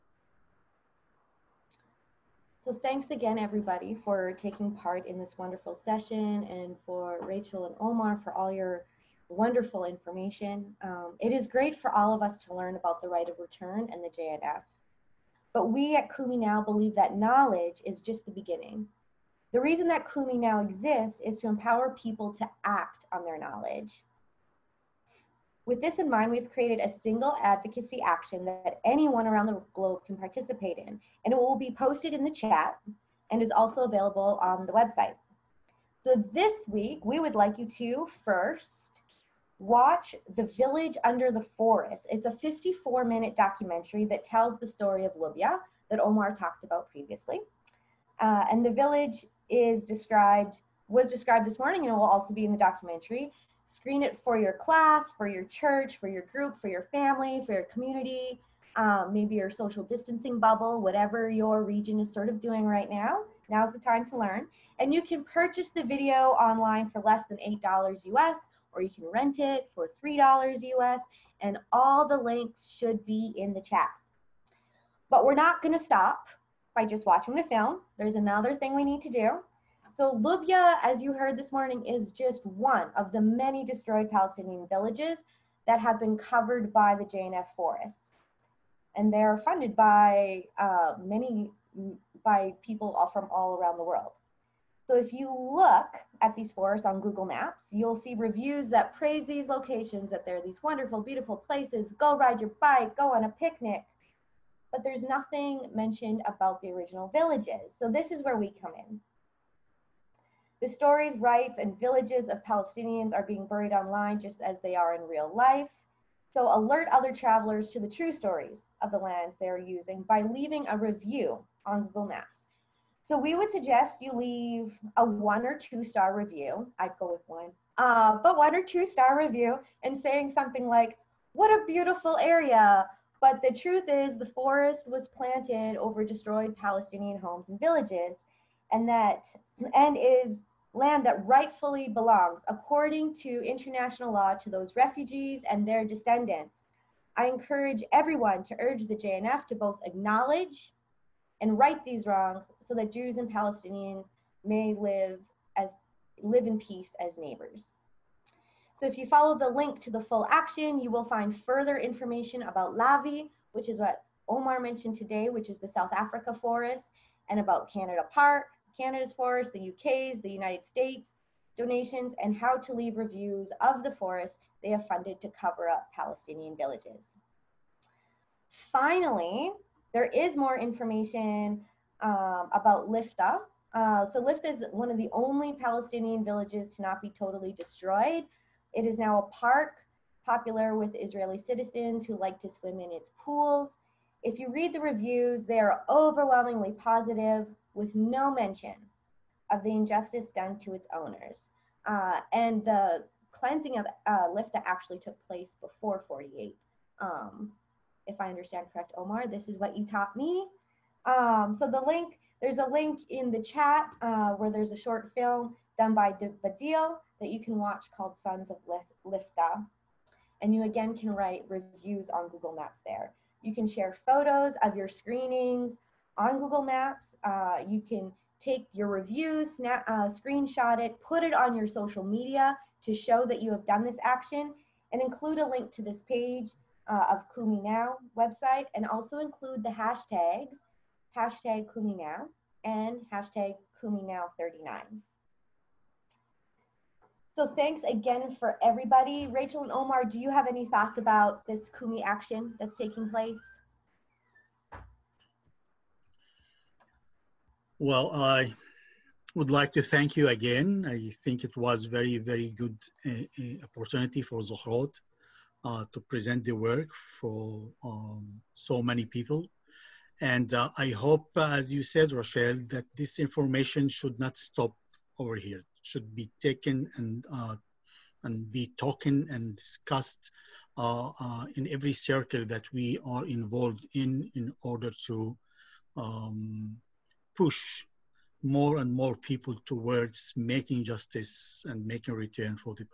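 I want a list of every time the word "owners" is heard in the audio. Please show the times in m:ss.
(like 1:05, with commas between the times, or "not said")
3:20.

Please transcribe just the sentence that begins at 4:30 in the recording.
And uh, I hope, as you said, Rochelle, that this information should not stop over here.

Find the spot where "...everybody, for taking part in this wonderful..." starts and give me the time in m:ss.
0:03.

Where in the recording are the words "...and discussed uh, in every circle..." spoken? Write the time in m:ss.
4:39.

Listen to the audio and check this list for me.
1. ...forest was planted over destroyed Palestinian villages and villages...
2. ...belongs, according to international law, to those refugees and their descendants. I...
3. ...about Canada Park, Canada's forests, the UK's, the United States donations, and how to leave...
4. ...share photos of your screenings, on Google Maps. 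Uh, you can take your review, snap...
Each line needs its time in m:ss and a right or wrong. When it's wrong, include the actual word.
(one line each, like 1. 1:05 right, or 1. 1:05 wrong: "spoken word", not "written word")
1. 2:14 wrong: "homes", not "villages"
2. 2:21 right
3. 2:47 right
4. 3:43 right.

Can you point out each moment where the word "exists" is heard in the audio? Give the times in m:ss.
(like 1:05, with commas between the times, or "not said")
0:20.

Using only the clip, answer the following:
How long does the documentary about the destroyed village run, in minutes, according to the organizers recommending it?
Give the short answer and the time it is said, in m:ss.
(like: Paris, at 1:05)
54, at 0:42.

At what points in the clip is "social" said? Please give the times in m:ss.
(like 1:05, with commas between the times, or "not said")
0:59, 3:51.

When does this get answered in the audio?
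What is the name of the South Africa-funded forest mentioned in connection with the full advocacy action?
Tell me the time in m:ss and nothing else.
2:42.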